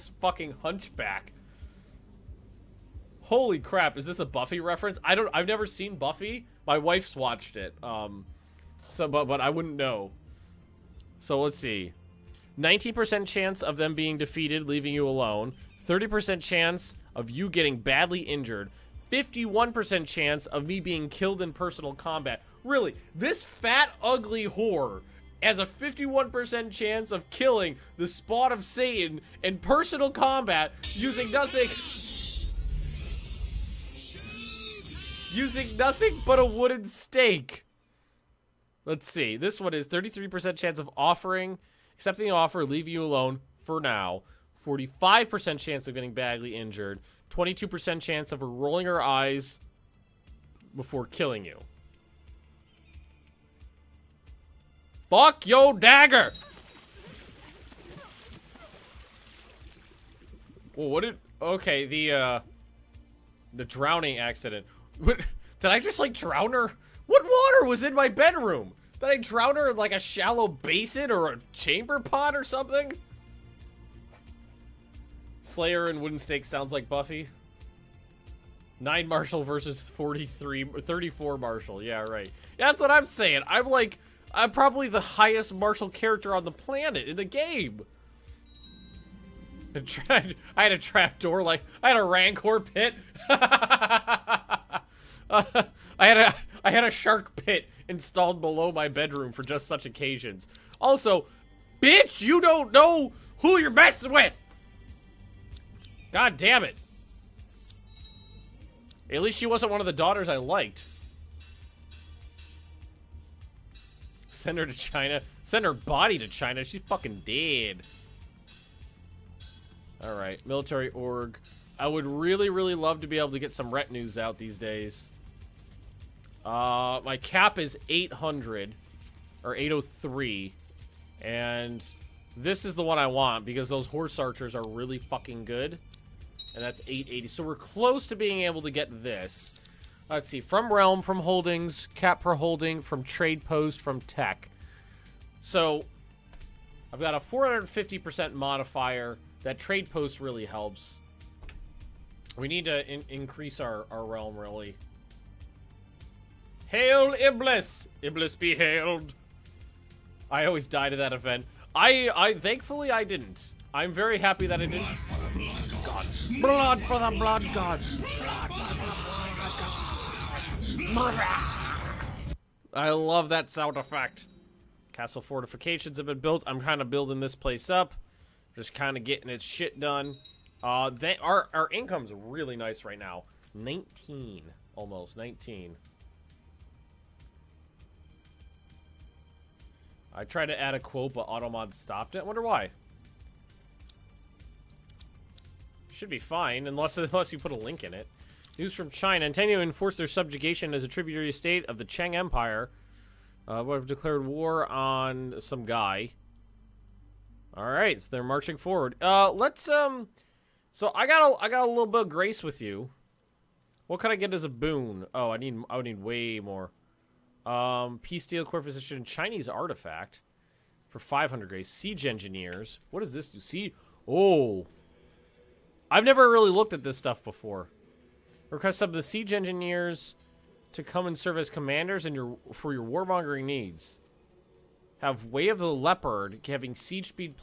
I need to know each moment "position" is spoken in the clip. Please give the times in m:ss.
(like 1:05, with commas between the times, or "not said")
3:38.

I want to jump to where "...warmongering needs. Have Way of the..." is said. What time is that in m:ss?
3:52.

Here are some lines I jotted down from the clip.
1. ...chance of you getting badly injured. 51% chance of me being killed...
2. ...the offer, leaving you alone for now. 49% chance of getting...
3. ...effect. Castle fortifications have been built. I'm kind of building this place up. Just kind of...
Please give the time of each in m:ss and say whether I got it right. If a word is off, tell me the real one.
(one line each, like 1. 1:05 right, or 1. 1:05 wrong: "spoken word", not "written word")
1. 0:16 right
2. 0:42 wrong: "45", not "49"
3. 2:53 right.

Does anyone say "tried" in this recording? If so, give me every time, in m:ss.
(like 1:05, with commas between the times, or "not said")
1:29, 3:10.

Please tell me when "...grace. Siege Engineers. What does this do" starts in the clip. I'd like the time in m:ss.
3:41.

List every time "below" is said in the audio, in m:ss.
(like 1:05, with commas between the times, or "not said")
1:38.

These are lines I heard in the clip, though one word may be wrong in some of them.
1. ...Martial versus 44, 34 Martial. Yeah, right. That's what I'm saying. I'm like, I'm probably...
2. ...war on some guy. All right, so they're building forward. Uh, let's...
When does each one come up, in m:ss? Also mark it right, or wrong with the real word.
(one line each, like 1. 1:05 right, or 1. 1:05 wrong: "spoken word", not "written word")
1. 1:19 wrong: "43", not "44"
2. 3:24 wrong: "marching", not "building".